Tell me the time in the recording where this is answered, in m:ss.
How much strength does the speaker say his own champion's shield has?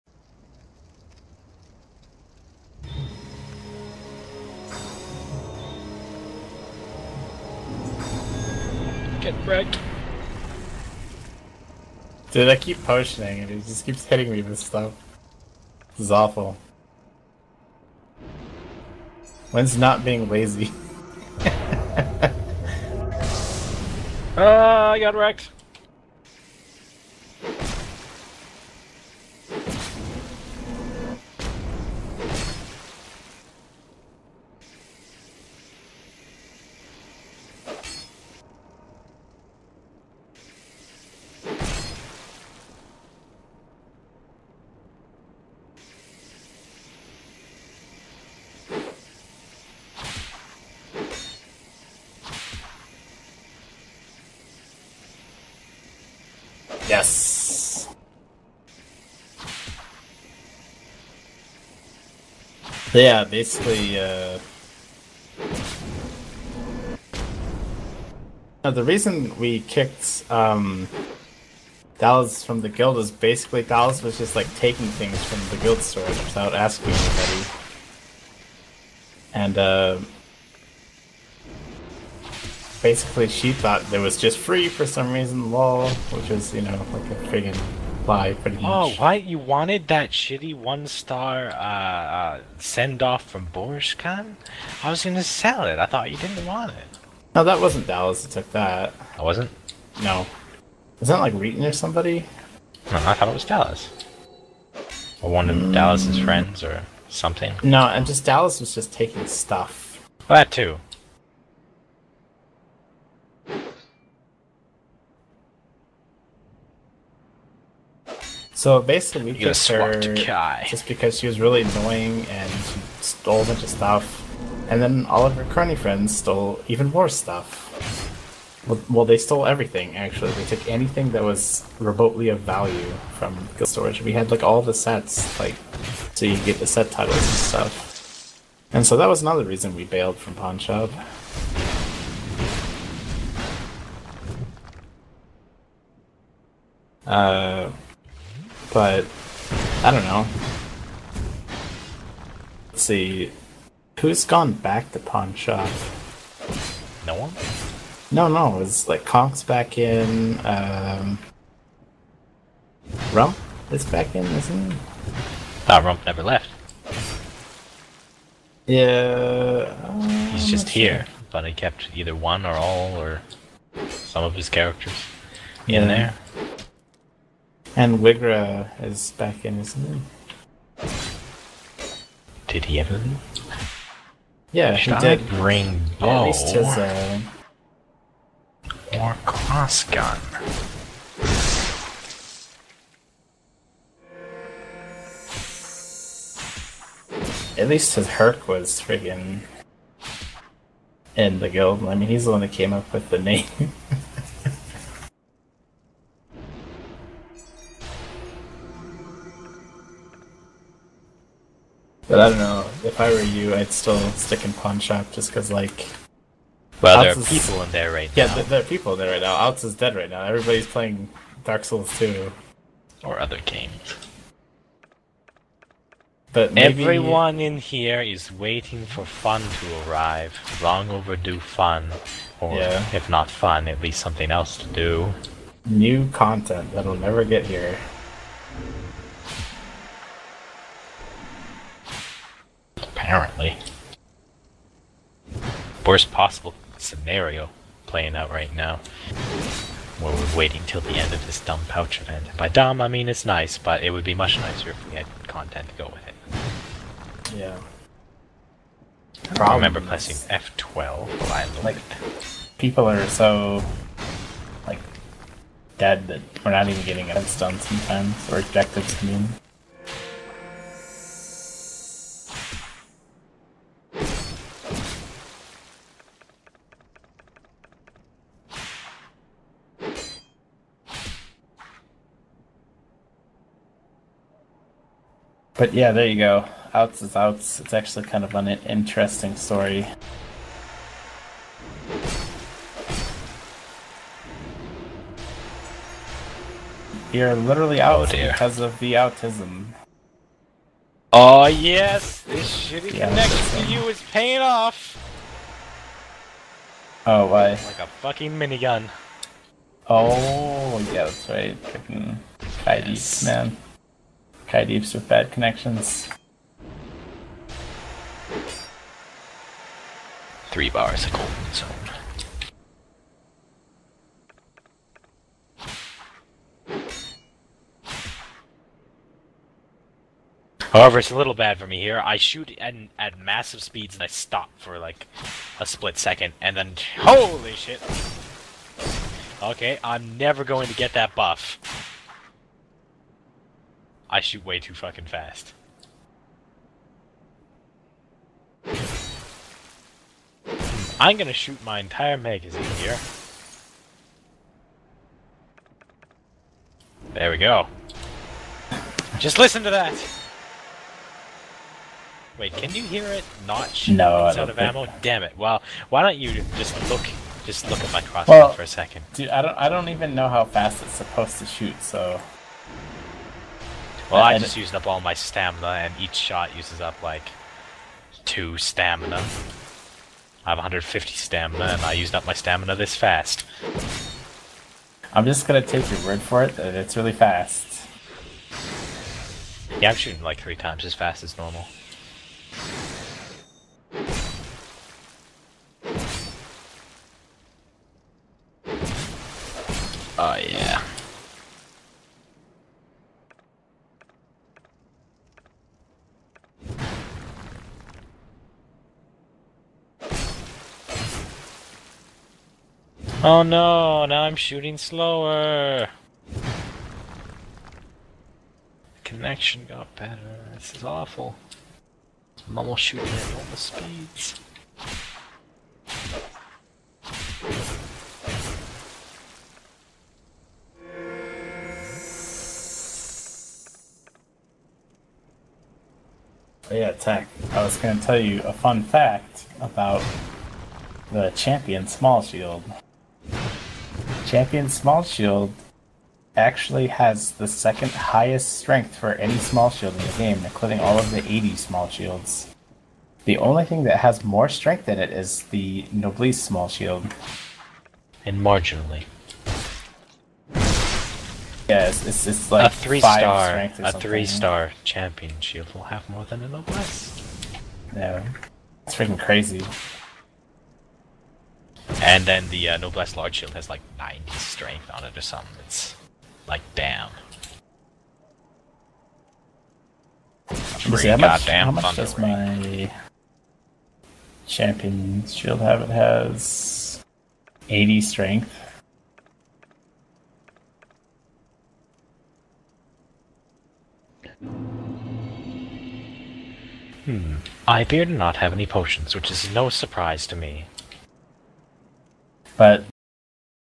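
8:07.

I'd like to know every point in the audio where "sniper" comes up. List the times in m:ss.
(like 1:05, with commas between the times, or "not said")
not said.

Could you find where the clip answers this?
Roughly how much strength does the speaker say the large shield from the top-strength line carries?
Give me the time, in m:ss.
7:53.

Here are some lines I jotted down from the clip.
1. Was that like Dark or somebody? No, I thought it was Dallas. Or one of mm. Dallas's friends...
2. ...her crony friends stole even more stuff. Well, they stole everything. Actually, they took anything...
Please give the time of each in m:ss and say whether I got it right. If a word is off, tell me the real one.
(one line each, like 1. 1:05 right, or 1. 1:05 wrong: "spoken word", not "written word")
1. 1:40 wrong: "Wheaton", not "Dark"
2. 2:05 right.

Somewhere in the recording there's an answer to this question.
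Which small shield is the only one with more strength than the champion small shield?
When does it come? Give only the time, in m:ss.
7:35.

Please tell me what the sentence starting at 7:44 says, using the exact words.
three star champion shield will have more than a Noblesse.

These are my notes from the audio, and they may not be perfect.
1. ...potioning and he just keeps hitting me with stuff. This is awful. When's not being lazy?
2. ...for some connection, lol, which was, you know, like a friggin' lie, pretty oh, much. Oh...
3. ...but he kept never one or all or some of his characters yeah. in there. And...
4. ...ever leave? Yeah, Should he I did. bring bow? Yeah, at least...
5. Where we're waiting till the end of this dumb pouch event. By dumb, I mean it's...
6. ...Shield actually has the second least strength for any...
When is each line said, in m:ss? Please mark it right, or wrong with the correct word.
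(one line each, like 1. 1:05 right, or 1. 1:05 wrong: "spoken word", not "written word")
1. 0:12 right
2. 1:24 wrong: "reason", not "connection"
3. 2:51 wrong: "either", not "never"
4. 3:02 right
5. 4:09 right
6. 7:25 wrong: "highest", not "least".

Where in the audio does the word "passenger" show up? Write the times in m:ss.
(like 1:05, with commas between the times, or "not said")
not said.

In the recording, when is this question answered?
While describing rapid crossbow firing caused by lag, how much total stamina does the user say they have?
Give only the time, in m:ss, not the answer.
6:20.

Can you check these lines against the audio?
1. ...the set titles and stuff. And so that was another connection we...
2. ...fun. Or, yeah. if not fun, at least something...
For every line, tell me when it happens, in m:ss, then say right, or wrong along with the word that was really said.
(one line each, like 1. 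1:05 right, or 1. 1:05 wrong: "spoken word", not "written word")
1. 2:16 wrong: "reason", not "connection"
2. 3:51 right.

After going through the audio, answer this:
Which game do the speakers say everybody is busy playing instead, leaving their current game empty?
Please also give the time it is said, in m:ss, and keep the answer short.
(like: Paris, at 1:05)
Dark Souls 2, at 3:41.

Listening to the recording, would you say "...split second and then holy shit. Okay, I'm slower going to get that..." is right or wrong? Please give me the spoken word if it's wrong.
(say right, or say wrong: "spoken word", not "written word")
wrong: "never", not "slower".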